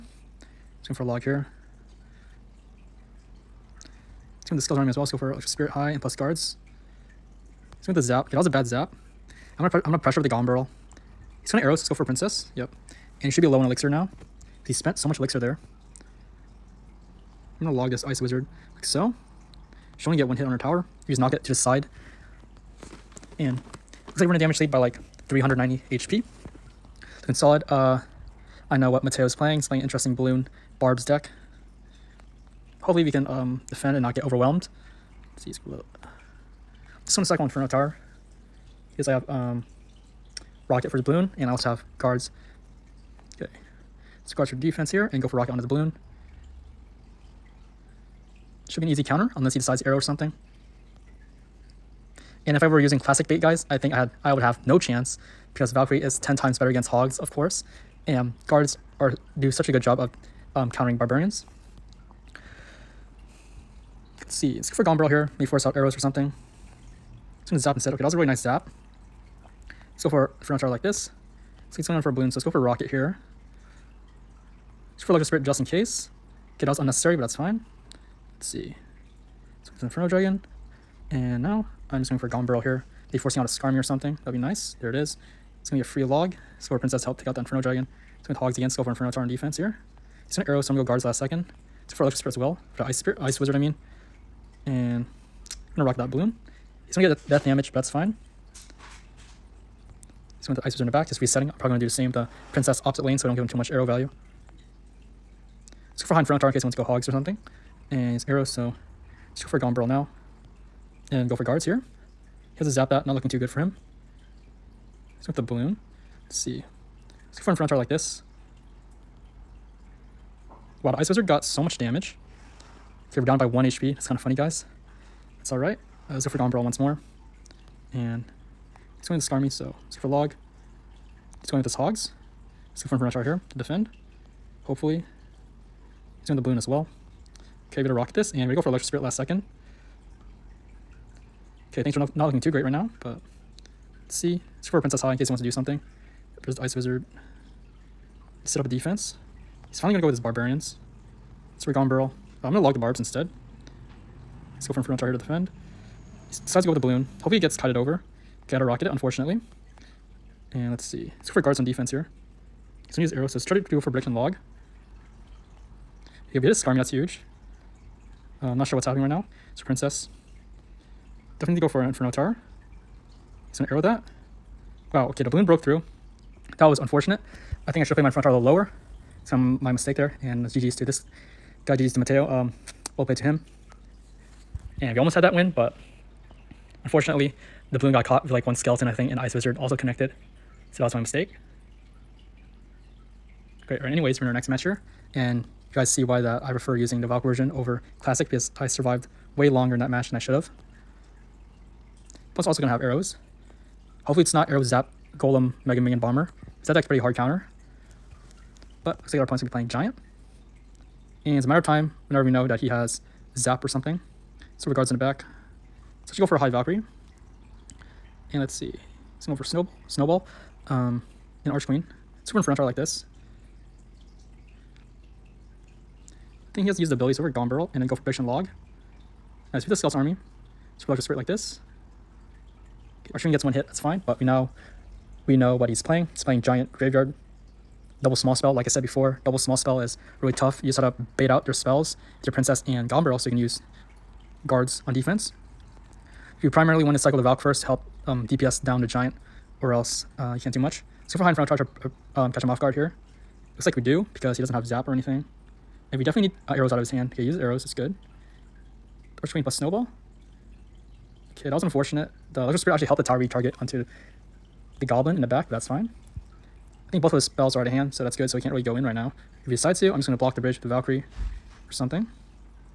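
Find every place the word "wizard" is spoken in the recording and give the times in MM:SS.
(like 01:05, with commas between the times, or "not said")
00:18, 01:33, 01:40, 02:01, 02:26, 03:09.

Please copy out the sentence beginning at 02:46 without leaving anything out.
He'll hit a Skarmy, that's huge.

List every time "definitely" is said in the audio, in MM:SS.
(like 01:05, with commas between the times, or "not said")
02:51, 04:16.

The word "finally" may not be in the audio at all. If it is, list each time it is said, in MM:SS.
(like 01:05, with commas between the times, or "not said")
02:29.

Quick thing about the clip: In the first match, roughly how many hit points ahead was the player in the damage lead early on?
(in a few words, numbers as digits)
390.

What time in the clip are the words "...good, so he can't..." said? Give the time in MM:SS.
04:28.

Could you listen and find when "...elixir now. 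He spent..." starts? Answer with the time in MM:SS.
00:13.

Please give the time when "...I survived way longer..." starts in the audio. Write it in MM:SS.
03:18.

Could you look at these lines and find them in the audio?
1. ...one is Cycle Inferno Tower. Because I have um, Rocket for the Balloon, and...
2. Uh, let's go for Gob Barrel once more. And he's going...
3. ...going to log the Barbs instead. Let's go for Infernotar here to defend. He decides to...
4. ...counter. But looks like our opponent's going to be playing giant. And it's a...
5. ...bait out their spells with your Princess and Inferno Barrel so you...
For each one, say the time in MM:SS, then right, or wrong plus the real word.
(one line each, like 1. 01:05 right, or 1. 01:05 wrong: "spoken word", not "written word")
1. 00:37 right
2. 02:06 right
3. 02:32 right
4. 03:27 right
5. 04:01 wrong: "Goblin", not "Inferno".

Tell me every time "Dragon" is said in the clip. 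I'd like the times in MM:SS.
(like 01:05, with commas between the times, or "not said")
01:20, 01:27.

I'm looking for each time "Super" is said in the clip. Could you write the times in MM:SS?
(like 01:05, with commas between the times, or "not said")
03:42, 03:50.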